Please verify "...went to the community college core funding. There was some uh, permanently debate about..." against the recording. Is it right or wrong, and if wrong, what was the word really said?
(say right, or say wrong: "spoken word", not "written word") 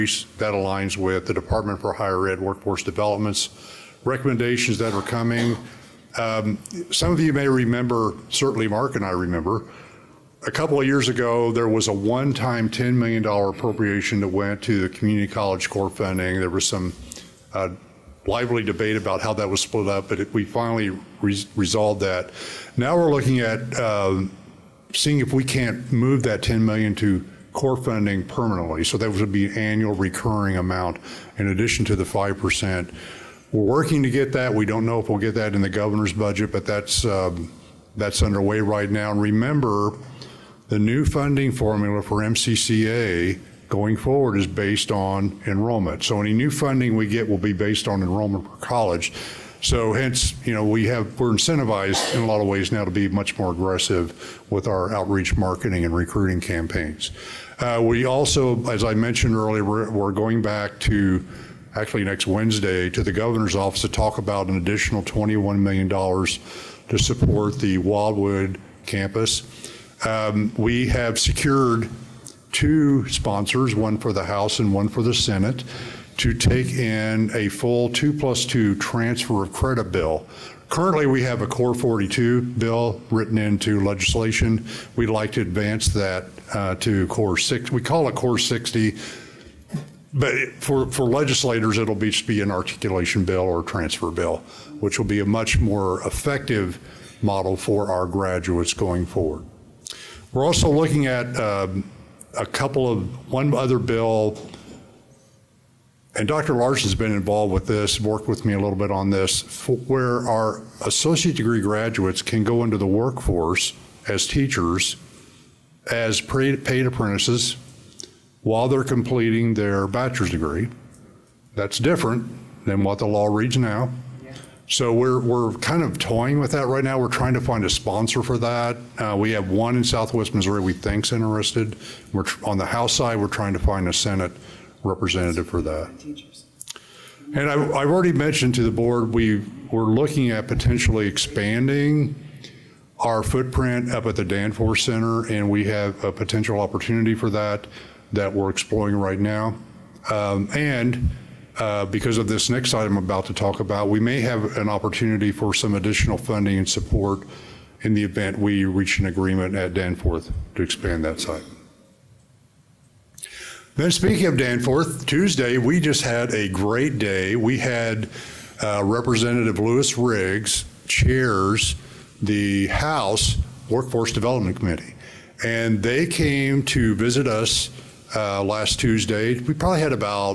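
wrong: "lively", not "permanently".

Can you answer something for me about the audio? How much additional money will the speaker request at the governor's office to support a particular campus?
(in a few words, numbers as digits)
$21 million.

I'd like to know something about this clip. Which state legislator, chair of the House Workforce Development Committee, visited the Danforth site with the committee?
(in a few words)
Louis Riggs.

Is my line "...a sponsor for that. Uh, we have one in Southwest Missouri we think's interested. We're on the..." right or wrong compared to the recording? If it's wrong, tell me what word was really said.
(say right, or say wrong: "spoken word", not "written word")
right.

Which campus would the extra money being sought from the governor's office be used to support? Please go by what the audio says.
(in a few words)
Wildwood.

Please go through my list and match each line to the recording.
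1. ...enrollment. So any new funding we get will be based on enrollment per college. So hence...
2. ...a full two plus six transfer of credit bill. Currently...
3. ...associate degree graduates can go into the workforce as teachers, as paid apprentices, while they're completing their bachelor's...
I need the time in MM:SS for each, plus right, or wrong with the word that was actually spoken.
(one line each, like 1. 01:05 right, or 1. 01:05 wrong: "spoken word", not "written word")
1. 00:45 right
2. 01:17 wrong: "two", not "six"
3. 01:50 right.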